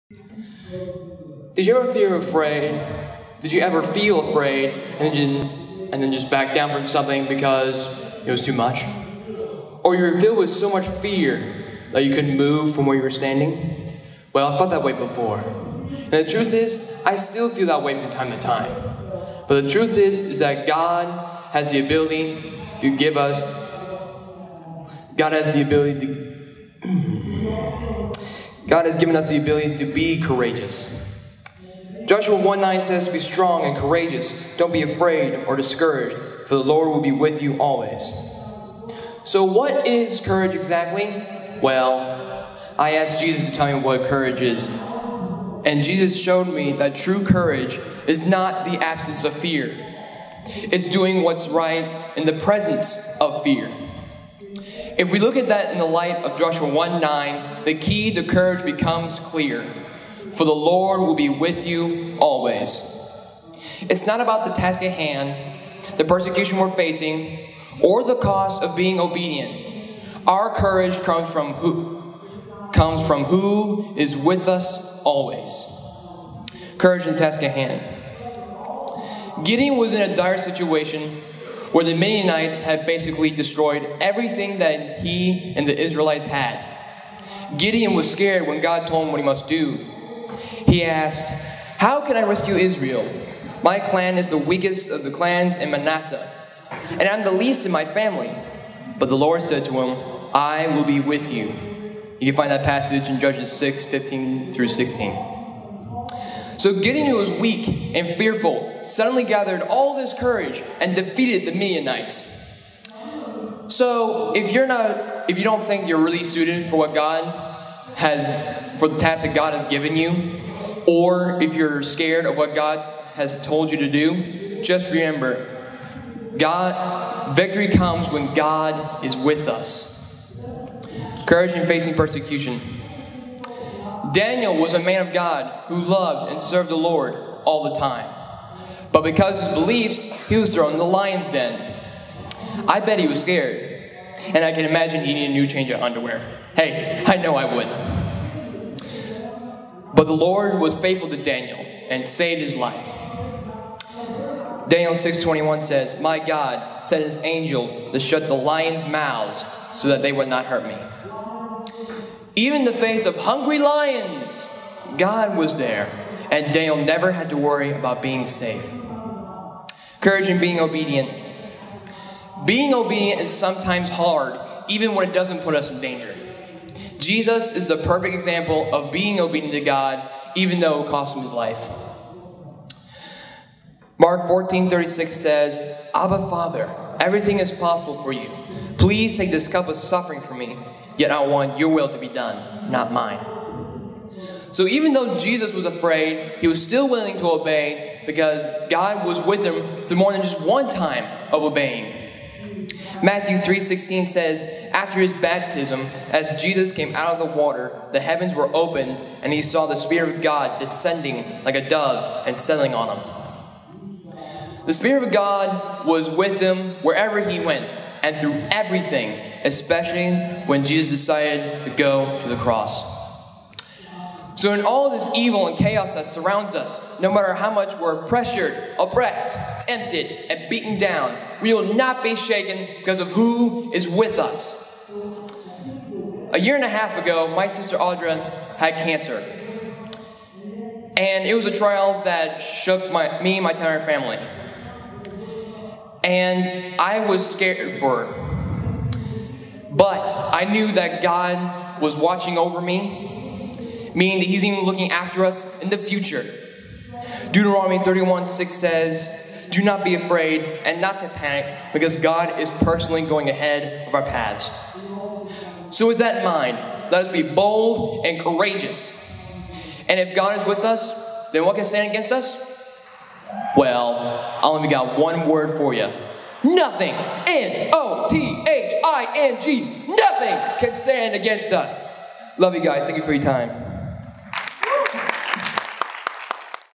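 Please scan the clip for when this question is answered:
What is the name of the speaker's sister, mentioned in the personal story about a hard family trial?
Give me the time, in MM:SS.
03:57.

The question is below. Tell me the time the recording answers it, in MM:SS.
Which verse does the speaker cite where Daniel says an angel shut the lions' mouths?
02:34.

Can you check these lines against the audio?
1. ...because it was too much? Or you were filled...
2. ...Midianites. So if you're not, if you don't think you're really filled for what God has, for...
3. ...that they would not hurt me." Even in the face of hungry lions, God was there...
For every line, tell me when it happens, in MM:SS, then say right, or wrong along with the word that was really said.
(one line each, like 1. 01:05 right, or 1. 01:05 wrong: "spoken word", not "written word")
1. 00:07 right
2. 01:51 wrong: "suited", not "filled"
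3. 02:39 right.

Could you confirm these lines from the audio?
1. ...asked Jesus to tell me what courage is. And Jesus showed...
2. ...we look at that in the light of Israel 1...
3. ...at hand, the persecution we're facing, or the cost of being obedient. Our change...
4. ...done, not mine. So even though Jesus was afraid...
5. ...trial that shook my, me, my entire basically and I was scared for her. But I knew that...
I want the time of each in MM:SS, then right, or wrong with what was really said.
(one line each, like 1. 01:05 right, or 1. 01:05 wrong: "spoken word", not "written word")
1. 00:42 right
2. 00:55 wrong: "Joshua", not "Israel"
3. 01:04 wrong: "courage", not "change"
4. 03:12 right
5. 04:01 wrong: "family", not "basically".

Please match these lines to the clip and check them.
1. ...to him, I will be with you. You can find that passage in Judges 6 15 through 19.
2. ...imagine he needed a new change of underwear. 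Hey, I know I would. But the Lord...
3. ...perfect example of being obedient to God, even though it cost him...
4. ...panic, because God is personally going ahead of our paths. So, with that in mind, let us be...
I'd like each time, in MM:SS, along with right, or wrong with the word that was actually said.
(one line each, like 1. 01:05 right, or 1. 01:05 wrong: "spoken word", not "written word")
1. 01:39 wrong: "16", not "19"
2. 02:24 right
3. 02:57 right
4. 04:21 right.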